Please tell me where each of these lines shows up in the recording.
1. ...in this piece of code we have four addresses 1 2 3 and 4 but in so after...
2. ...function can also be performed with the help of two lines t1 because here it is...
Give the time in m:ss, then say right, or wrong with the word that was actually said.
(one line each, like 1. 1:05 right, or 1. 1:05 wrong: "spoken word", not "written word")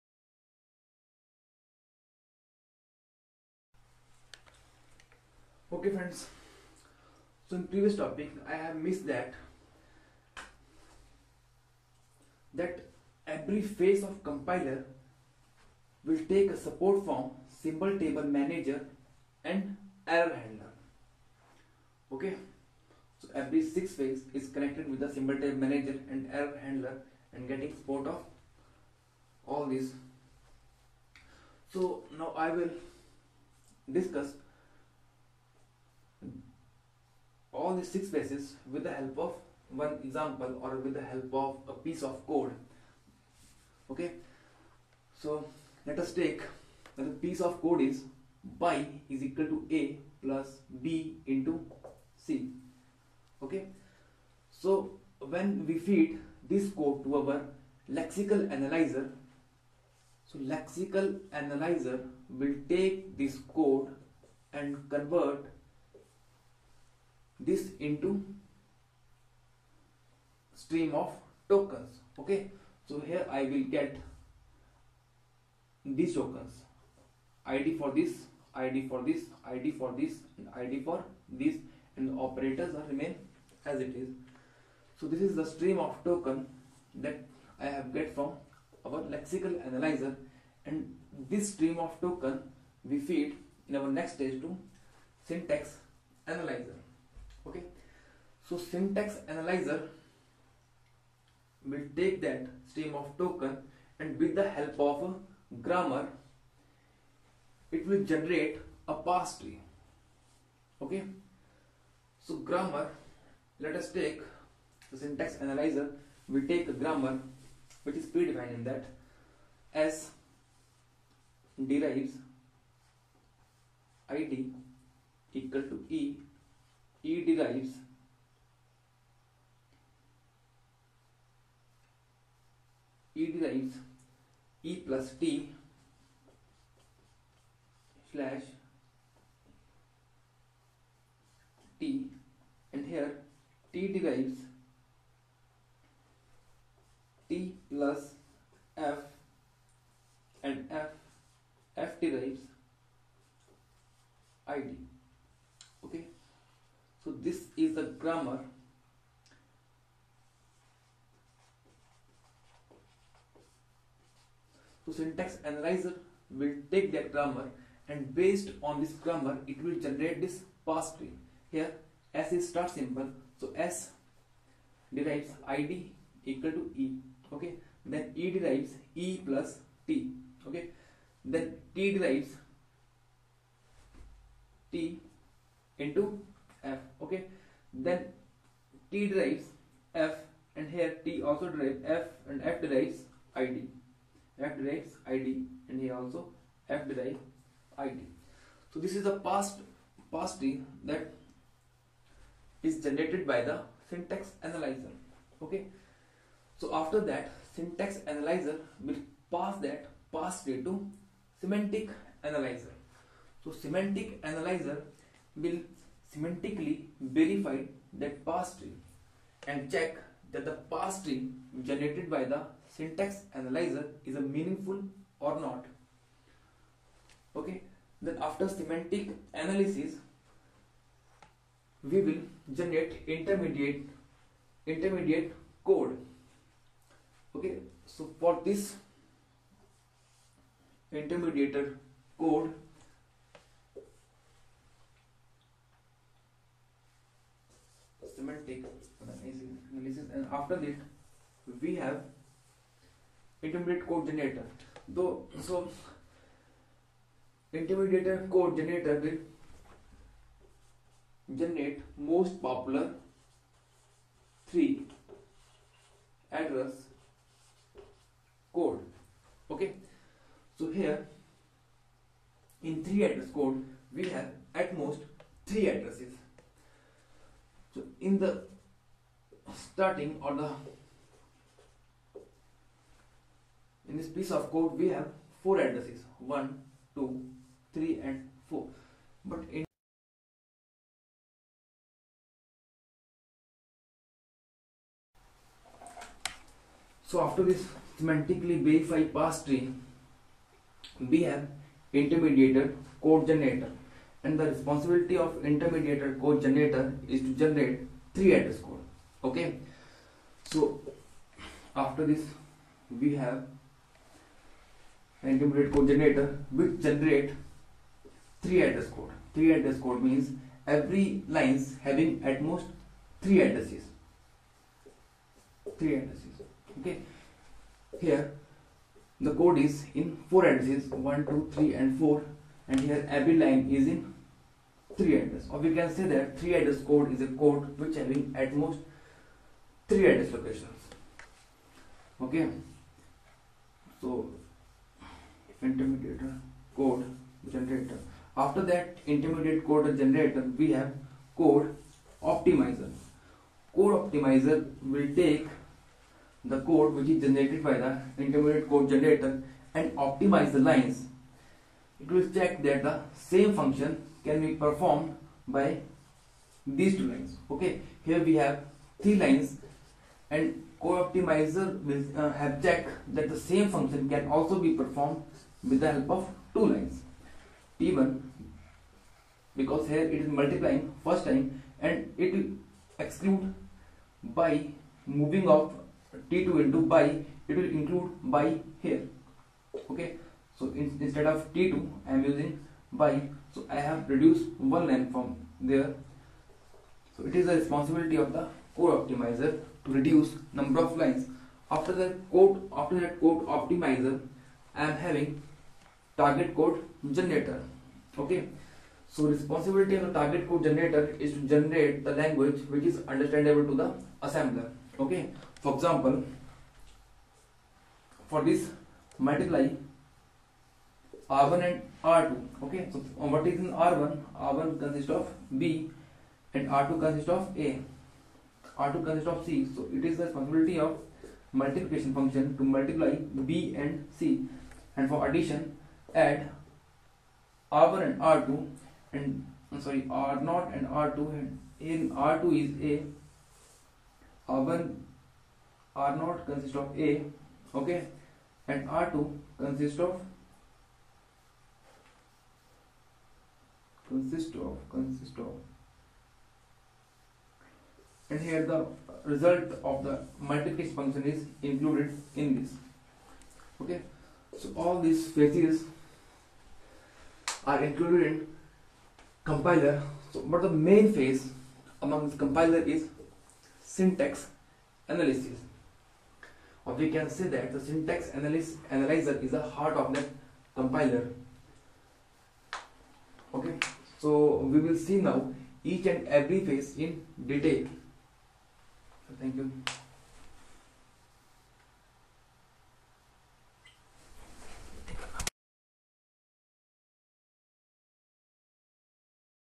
1. 4:43 right
2. 6:13 right.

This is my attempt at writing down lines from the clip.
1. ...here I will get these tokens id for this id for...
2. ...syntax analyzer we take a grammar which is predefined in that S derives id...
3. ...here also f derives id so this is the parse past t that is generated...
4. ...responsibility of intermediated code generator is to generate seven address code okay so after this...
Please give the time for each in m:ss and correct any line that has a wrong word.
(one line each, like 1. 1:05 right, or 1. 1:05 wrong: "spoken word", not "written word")
1. 1:13 right
2. 1:55 right
3. 3:15 right
4. 5:04 wrong: "three", not "seven".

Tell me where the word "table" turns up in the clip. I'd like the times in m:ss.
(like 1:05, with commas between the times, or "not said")
0:18, 0:25.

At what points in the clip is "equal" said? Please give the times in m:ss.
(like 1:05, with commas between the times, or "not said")
0:49, 2:05, 2:56.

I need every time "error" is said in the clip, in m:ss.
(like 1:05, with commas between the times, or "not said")
0:20, 0:26.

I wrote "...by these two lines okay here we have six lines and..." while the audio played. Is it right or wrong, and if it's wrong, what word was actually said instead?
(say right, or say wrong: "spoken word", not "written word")
wrong: "three", not "six".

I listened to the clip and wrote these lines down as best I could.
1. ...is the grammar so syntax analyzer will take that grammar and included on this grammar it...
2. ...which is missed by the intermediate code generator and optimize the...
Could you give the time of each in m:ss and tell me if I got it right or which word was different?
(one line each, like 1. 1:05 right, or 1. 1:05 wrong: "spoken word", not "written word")
1. 2:37 wrong: "based", not "included"
2. 5:56 wrong: "generated", not "missed".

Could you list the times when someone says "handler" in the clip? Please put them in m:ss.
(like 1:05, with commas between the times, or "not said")
0:20, 0:26.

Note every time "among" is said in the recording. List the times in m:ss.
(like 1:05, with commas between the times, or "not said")
7:52.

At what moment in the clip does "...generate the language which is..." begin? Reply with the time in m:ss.
6:51.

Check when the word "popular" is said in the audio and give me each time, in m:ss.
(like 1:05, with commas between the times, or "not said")
4:22.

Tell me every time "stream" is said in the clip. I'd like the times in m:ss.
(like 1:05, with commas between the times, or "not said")
1:10, 1:25, 1:31, 1:42.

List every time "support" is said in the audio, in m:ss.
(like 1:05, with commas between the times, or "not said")
0:16, 0:27.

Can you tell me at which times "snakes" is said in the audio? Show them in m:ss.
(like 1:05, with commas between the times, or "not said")
not said.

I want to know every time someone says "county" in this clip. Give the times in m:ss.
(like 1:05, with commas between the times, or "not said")
not said.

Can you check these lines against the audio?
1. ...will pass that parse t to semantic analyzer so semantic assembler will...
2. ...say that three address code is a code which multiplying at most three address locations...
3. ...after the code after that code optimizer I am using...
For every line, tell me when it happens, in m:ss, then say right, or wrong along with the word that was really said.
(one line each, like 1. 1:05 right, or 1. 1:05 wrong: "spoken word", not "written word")
1. 3:28 wrong: "analyzer", not "assembler"
2. 5:35 wrong: "having", not "multiplying"
3. 6:41 wrong: "having", not "using".